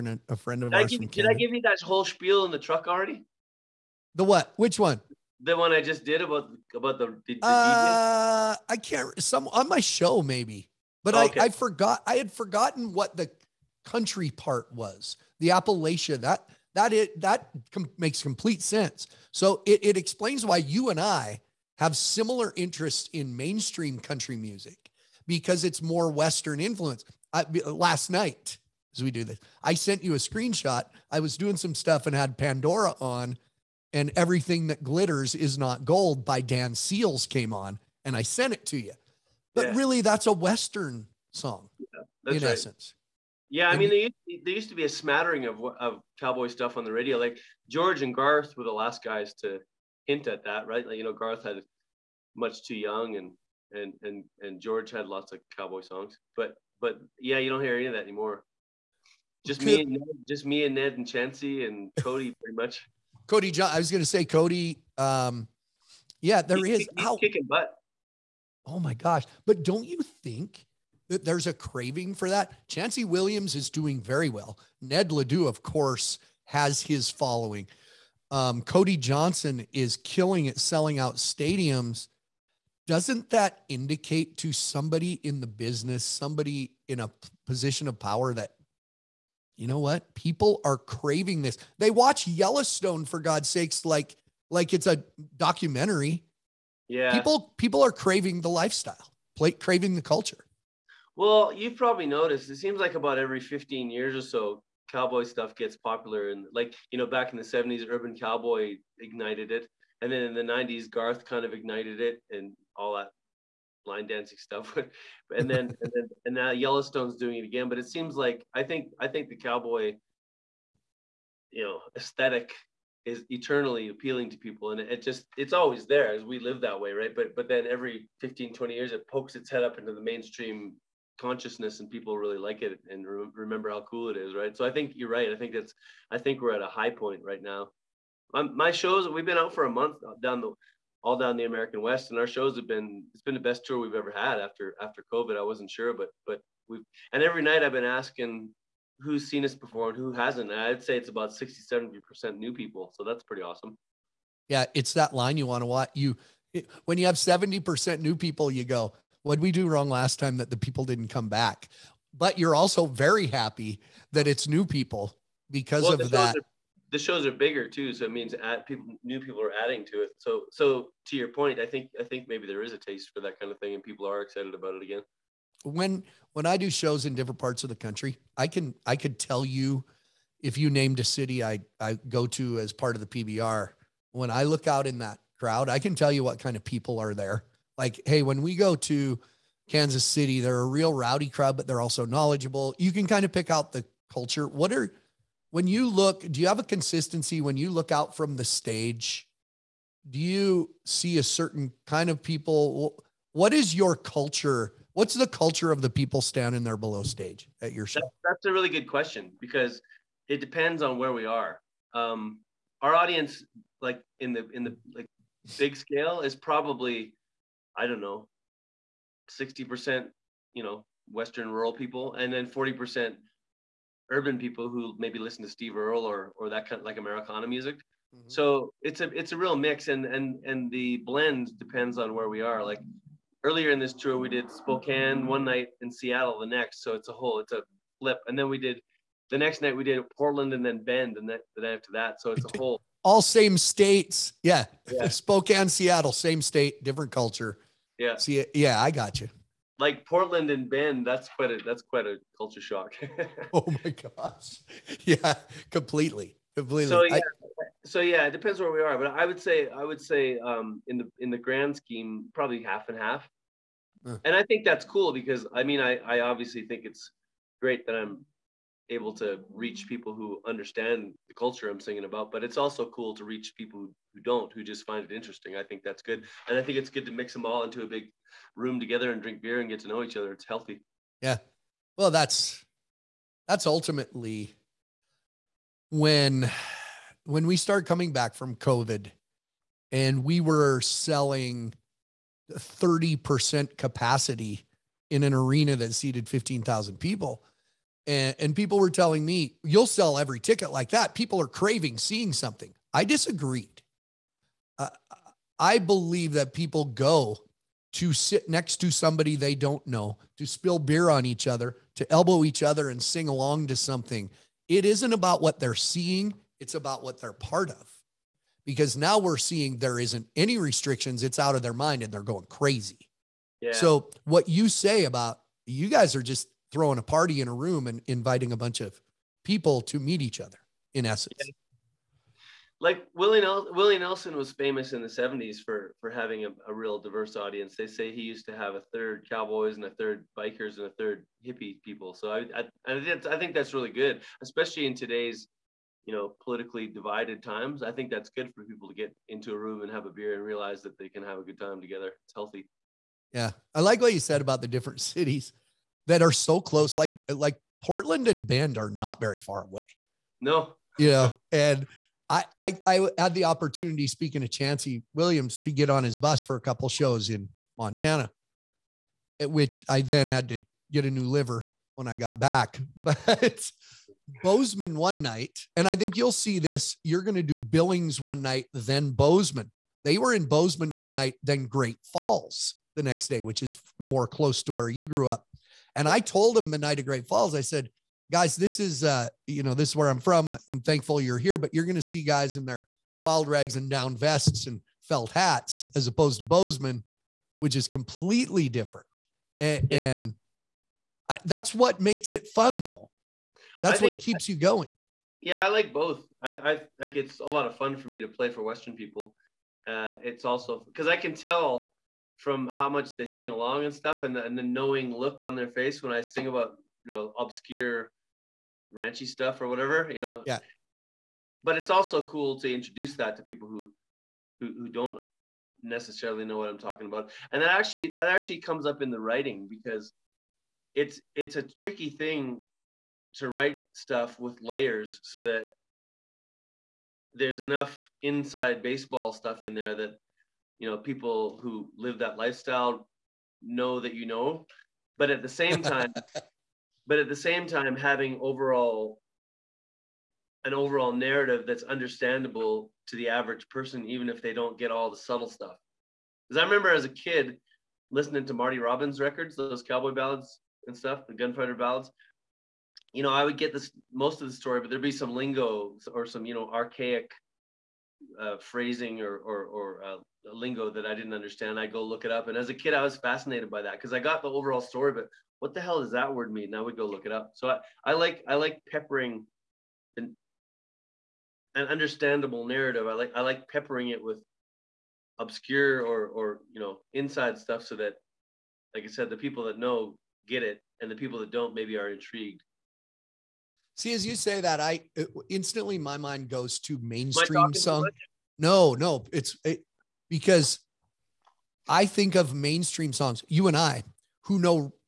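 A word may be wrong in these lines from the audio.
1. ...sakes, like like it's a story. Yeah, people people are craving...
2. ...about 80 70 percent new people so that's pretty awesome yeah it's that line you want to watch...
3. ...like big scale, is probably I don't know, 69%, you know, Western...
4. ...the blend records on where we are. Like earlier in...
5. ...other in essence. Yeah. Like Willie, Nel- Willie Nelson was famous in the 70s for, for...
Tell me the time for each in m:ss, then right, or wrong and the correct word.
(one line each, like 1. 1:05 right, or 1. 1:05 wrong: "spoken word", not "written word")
1. 1:33 wrong: "documentary", not "story"
2. 2:31 wrong: "60", not "80"
3. 3:34 wrong: "60", not "69"
4. 3:50 wrong: "depends", not "records"
5. 5:30 right.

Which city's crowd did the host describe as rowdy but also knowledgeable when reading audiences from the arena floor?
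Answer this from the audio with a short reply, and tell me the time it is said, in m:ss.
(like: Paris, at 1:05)
Kansas City, at 3:09.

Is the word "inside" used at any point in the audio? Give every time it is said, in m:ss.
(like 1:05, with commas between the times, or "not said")
7:18, 8:07.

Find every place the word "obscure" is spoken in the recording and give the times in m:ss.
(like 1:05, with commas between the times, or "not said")
6:57, 8:05.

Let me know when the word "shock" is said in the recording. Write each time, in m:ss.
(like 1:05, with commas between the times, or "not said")
4:12.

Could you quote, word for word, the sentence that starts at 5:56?
Like like Portland and Bend are not very far away.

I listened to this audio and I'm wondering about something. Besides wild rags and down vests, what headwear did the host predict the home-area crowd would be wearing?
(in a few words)
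Felt hats.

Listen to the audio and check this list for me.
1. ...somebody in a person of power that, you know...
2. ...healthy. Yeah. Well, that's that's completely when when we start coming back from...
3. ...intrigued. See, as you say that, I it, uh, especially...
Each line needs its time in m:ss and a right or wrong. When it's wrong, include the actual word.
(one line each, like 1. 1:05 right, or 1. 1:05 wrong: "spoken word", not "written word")
1. 1:26 wrong: "position", not "person"
2. 4:40 wrong: "ultimately", not "completely"
3. 8:12 wrong: "instantly", not "especially".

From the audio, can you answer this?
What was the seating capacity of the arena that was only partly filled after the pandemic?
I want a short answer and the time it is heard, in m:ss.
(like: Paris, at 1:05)
15,000, at 4:56.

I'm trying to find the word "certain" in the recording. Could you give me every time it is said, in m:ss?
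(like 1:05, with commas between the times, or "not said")
3:21.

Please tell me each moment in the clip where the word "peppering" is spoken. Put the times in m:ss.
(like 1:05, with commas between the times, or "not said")
7:58, 8:03.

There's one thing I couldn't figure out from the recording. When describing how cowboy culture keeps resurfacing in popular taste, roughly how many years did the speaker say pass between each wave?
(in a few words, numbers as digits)
15 years.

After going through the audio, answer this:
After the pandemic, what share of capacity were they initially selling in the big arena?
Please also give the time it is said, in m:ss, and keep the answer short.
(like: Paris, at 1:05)
30%, at 4:52.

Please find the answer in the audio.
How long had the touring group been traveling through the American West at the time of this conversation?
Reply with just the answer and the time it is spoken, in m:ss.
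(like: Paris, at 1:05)
A month, at 2:19.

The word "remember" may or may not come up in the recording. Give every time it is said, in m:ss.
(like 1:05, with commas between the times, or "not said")
2:13, 7:36.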